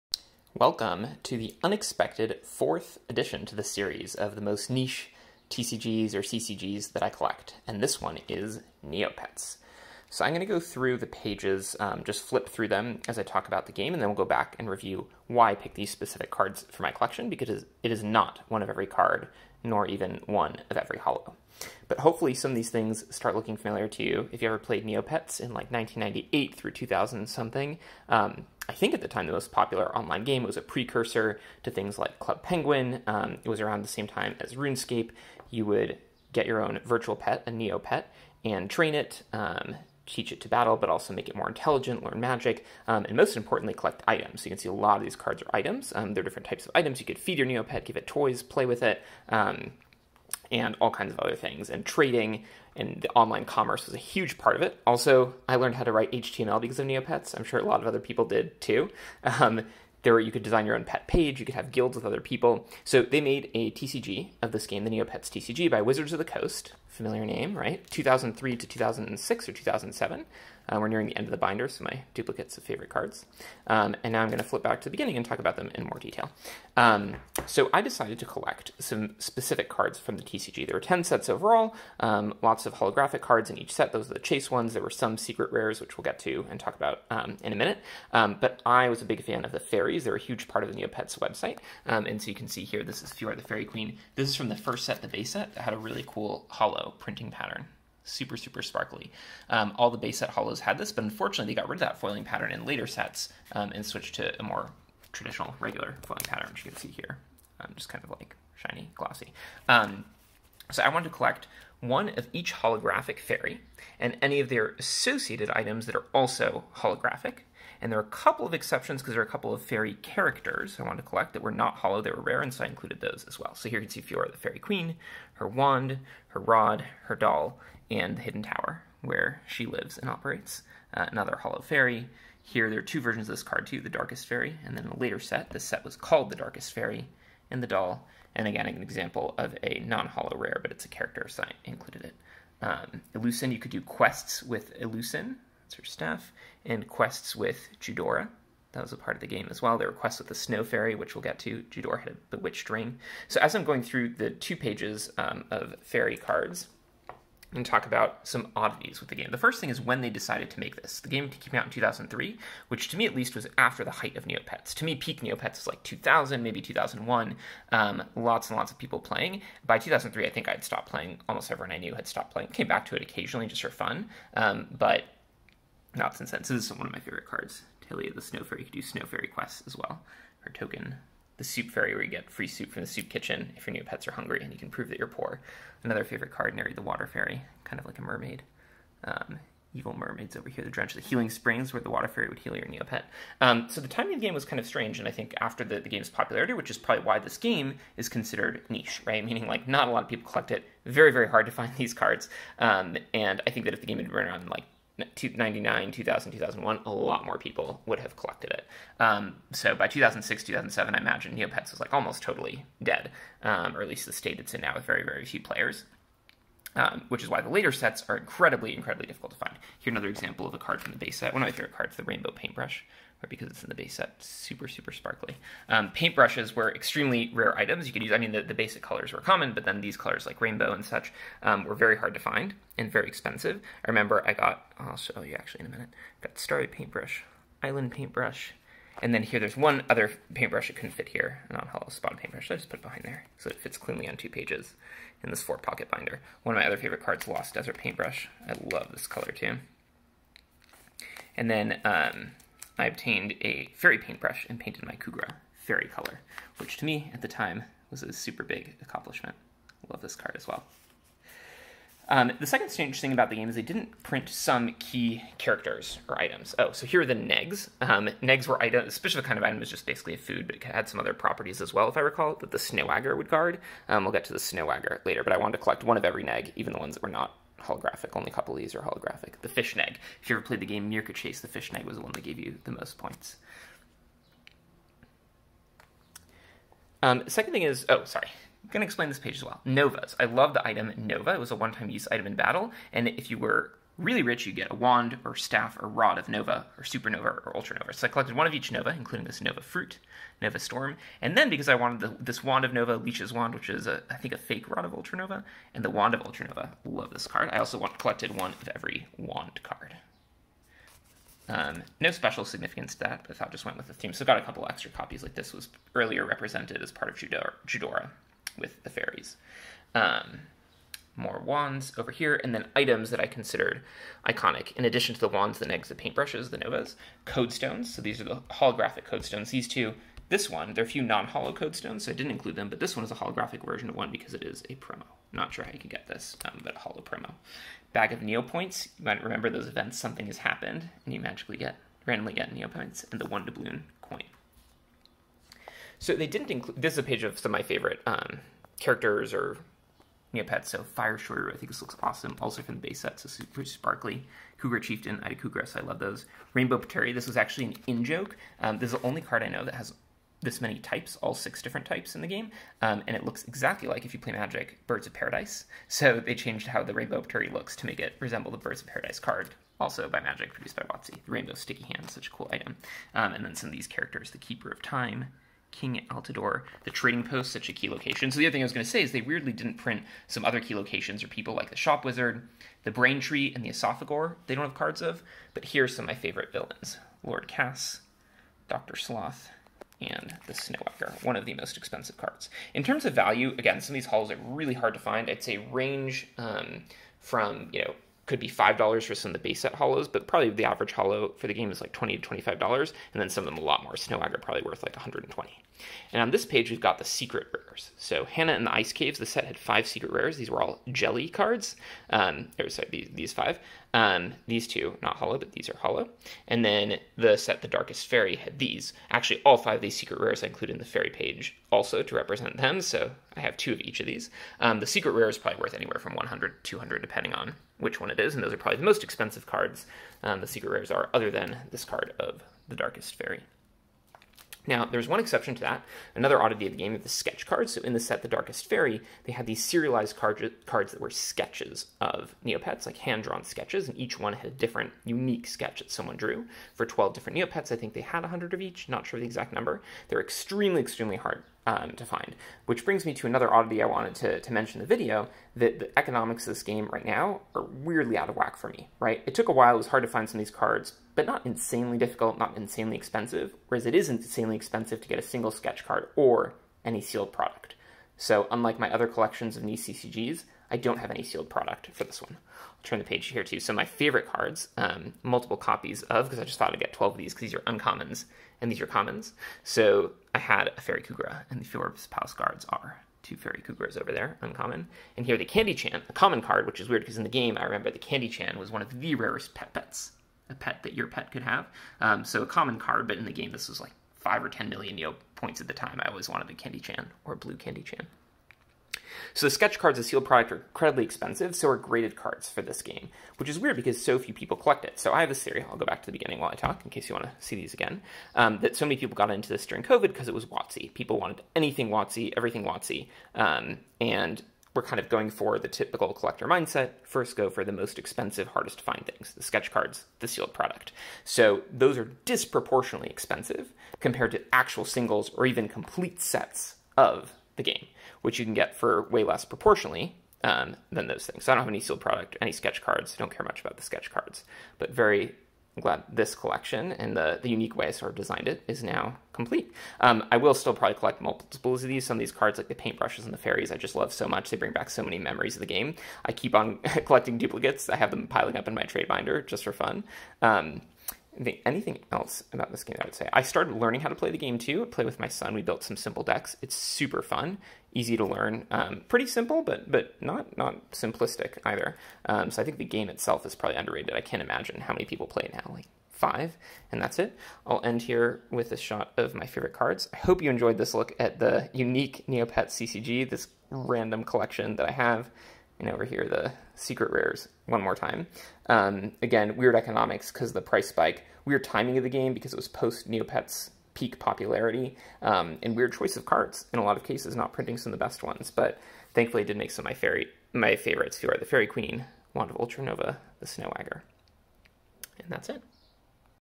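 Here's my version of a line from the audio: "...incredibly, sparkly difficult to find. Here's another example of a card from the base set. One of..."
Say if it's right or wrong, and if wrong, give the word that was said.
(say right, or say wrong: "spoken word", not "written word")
wrong: "incredibly", not "sparkly".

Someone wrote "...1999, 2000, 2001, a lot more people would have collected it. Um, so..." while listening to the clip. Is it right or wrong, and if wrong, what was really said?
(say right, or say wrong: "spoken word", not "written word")
right.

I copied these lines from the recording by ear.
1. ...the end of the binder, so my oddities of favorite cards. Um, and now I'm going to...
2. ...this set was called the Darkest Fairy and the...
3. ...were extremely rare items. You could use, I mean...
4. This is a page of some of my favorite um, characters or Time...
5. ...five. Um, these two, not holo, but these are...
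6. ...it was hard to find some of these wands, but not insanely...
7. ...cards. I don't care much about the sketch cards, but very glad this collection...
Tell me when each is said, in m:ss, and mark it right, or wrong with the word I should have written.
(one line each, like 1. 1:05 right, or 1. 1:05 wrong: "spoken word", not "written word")
1. 1:11 wrong: "duplicates", not "oddities"
2. 2:15 right
3. 3:46 right
4. 5:46 wrong: "Mega", not "Time"
5. 6:53 right
6. 7:39 wrong: "cards", not "wands"
7. 8:52 right.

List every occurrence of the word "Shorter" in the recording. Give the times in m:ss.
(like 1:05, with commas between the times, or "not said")
5:51.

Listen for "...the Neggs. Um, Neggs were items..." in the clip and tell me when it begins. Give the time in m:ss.
4:27.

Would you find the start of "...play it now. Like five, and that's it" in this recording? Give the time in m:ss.
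9:25.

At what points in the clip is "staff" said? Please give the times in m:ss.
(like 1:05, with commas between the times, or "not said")
2:25, 4:55.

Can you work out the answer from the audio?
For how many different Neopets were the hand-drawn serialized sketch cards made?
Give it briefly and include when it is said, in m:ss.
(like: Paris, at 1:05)
12, at 7:26.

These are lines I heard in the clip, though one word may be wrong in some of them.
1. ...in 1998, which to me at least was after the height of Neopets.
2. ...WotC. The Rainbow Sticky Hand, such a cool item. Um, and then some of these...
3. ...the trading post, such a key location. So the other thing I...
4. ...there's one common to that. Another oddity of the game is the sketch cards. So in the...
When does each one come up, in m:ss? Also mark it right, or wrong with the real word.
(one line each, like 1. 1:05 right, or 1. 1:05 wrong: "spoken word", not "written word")
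1. 2:41 wrong: "2003", not "1998"
2. 6:10 right
3. 6:16 right
4. 7:14 wrong: "exception", not "common".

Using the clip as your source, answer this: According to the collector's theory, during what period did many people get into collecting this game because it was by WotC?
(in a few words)
COVID.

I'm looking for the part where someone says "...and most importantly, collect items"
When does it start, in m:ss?
0:43.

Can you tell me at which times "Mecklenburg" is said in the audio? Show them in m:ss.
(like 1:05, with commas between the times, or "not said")
not said.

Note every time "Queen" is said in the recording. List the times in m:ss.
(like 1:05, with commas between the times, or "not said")
1:33, 2:04, 9:51.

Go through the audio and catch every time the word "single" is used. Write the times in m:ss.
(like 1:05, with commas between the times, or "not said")
7:45, 8:44.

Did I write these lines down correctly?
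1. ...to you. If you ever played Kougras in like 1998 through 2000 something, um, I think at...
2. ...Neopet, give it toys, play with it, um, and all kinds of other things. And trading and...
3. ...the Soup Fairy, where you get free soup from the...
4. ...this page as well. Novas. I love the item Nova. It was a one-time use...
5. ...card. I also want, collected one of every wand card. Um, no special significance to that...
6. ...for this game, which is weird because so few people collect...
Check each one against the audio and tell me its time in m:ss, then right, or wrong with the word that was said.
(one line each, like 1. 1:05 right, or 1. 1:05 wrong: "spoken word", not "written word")
1. 0:23 wrong: "Neopets", not "Kougras"
2. 0:47 right
3. 3:01 right
4. 4:49 right
5. 5:07 right
6. 8:22 right.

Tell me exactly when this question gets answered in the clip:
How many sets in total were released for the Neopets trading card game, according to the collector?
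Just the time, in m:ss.
1:20.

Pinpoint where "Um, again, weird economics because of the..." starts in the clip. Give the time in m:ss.
9:38.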